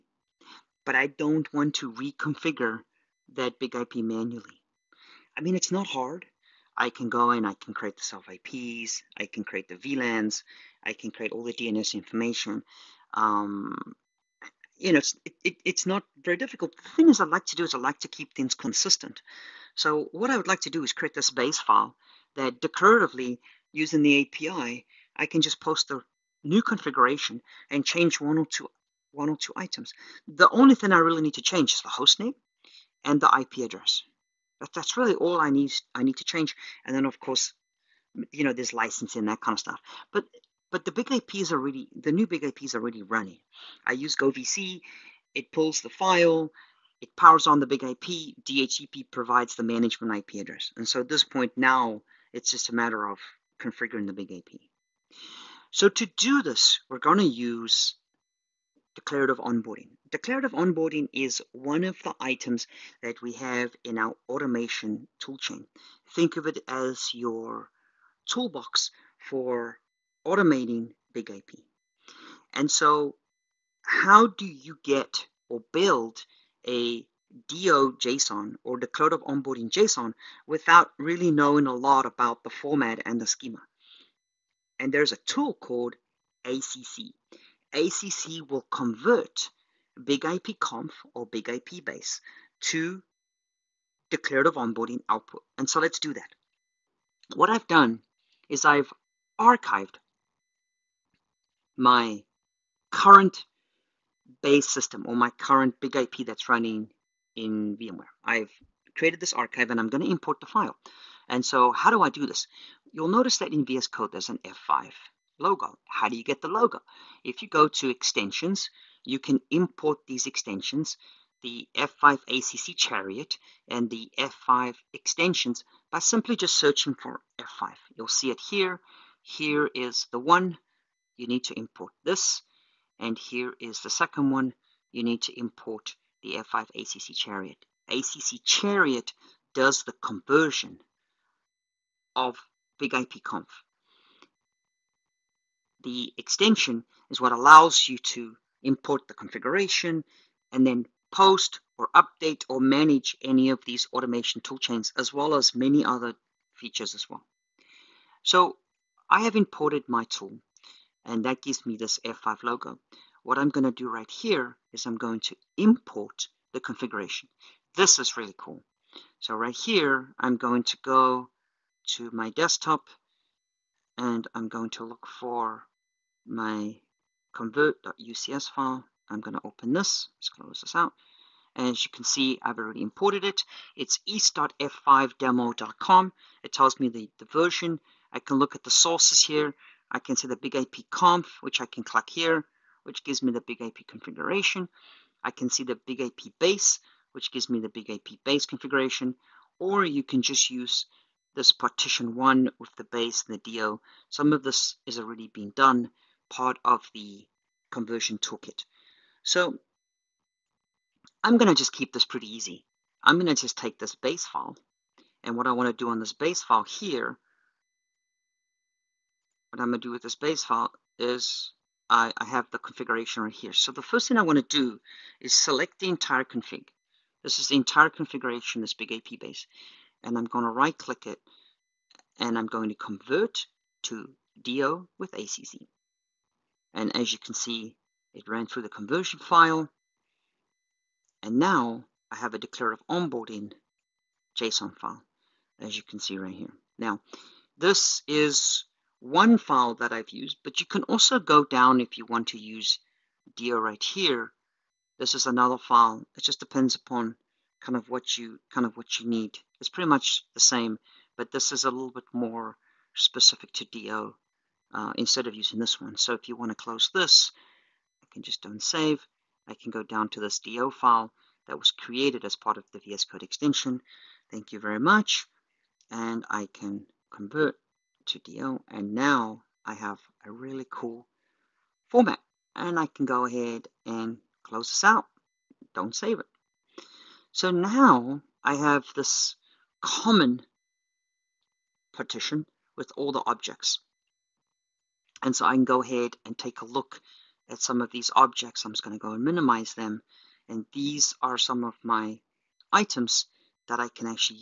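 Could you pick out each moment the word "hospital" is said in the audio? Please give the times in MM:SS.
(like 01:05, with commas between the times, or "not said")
not said.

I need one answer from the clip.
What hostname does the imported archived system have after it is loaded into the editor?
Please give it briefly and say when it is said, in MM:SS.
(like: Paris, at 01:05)
east.f5demo.com, at 03:04.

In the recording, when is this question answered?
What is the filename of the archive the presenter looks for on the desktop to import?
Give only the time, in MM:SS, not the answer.
02:57.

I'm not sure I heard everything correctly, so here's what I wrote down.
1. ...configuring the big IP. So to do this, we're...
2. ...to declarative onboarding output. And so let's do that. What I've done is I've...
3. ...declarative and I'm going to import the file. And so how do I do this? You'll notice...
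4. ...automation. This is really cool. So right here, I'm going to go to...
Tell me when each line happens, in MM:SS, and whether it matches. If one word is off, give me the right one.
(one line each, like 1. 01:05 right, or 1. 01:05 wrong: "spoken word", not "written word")
1. 00:53 right
2. 01:32 right
3. 01:49 wrong: "archive", not "declarative"
4. 02:46 wrong: "configuration", not "automation".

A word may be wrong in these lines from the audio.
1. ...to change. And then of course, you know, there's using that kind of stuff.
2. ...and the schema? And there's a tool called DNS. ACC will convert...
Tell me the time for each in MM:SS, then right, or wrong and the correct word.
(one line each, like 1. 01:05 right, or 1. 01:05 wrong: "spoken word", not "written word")
1. 00:36 wrong: "licensing", not "using"
2. 01:23 wrong: "ACC", not "DNS".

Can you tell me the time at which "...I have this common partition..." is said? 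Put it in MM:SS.
04:48.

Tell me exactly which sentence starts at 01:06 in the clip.
Think of it as your toolbox for automating big IP.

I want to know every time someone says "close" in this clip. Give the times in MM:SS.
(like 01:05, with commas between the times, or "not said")
03:00, 04:26, 04:44.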